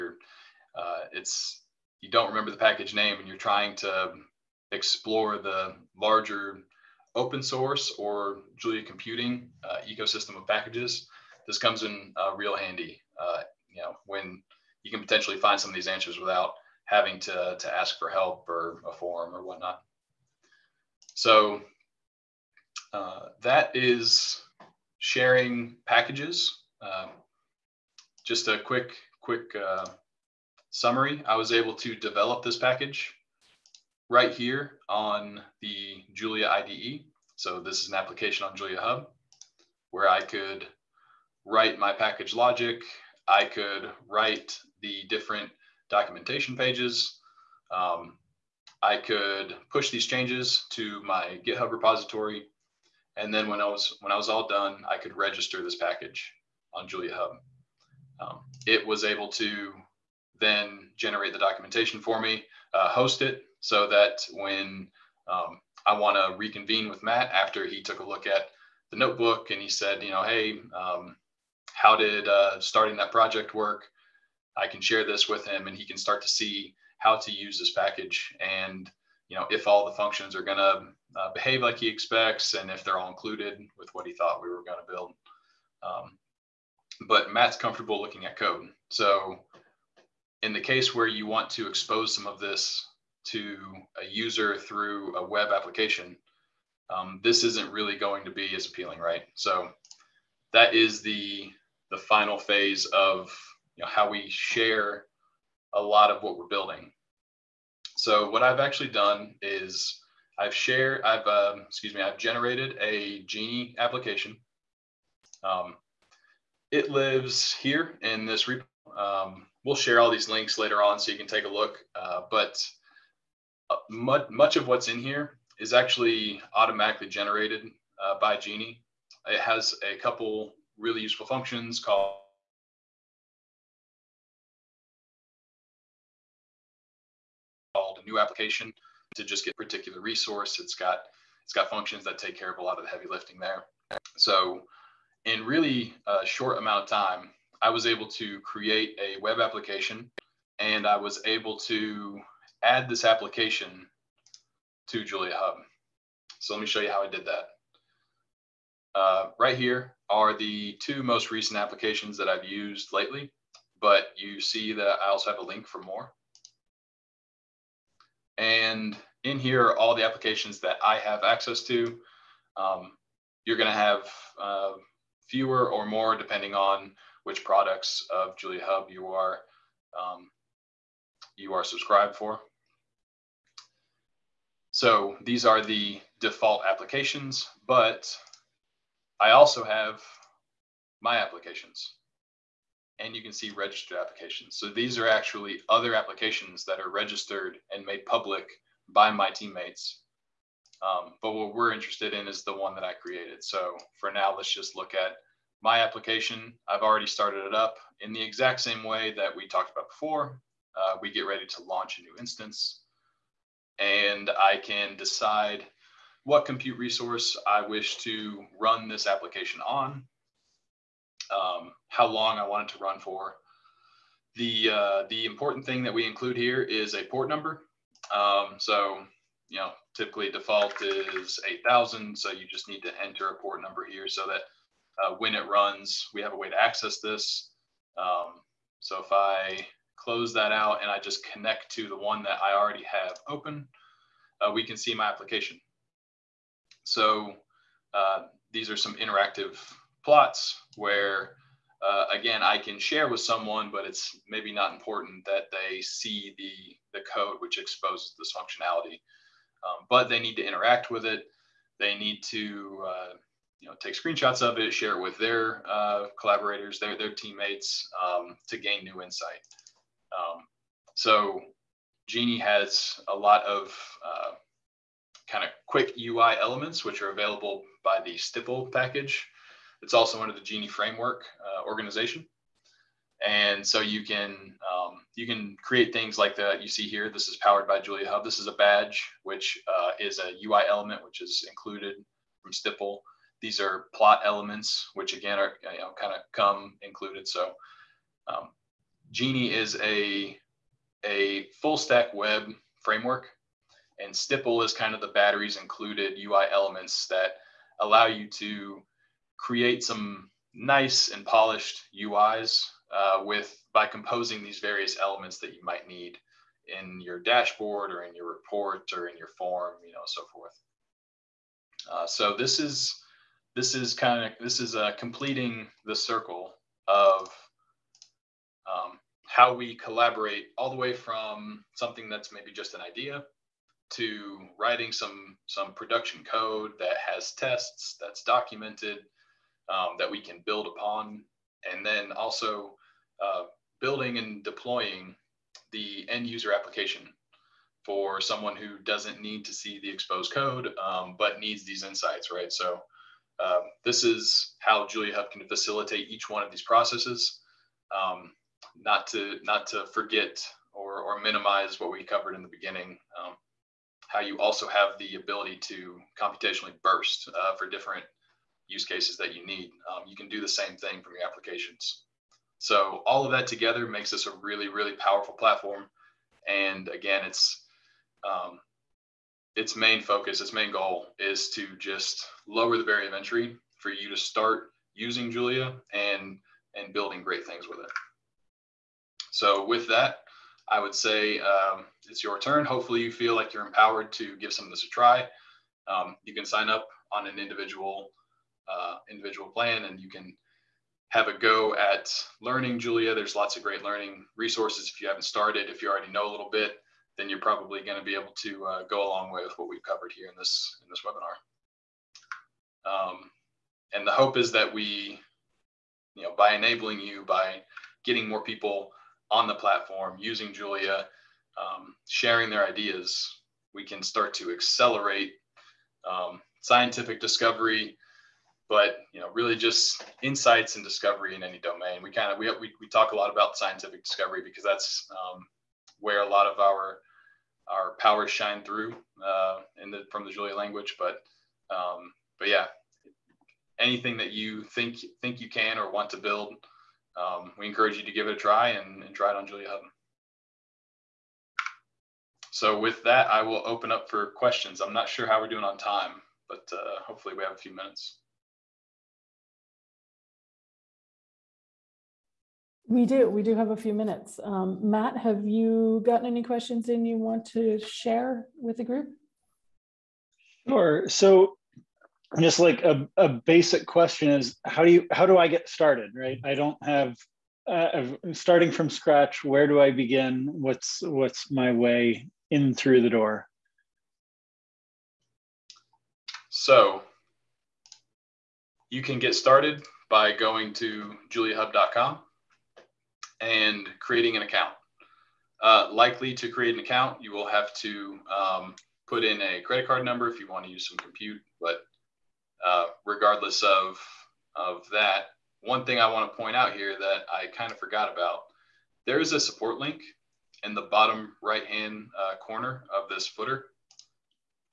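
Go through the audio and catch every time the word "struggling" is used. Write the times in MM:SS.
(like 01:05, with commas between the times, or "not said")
not said.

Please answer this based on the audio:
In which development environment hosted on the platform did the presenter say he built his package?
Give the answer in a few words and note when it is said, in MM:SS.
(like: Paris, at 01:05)
Julia IDE, at 00:36.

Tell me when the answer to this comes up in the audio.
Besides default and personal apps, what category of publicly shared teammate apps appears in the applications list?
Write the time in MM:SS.
03:13.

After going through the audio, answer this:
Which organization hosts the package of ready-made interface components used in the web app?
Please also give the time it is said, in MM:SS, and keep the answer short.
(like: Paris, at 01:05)
Genie Framework, at 04:40.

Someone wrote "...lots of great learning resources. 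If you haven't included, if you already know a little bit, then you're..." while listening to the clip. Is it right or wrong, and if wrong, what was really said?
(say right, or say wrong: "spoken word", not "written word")
wrong: "started", not "included".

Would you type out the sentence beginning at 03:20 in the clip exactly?
Um, but what we're interested in is the one that I created.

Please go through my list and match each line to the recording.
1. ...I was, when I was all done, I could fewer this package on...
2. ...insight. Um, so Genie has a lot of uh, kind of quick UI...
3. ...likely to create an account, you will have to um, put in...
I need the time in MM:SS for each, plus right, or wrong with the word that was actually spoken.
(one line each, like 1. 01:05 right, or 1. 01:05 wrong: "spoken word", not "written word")
1. 00:53 wrong: "register", not "fewer"
2. 04:29 right
3. 08:15 right.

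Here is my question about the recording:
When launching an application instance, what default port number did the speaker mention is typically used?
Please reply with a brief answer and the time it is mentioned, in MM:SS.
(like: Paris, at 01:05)
8000, at 03:51.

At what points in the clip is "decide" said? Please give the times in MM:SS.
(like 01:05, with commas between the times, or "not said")
03:34.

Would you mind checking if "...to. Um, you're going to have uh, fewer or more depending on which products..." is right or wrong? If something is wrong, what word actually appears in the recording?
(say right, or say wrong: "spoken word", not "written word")
right.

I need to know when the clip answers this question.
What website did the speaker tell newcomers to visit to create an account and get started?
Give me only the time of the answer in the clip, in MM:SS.
08:11.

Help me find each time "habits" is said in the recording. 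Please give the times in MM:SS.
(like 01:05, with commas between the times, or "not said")
not said.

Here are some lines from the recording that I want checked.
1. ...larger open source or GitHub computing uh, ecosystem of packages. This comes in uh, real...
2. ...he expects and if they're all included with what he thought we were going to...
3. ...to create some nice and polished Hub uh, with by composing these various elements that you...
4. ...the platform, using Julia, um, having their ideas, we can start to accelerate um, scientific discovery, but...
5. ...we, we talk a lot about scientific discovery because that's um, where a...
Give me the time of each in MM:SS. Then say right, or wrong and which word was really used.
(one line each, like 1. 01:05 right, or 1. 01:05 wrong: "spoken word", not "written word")
1. 00:05 wrong: "Julia", not "GitHub"
2. 01:21 right
3. 05:08 wrong: "UIs", not "Hub"
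4. 06:59 wrong: "sharing", not "having"
5. 07:12 right.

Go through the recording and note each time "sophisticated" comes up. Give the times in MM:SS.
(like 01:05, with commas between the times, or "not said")
not said.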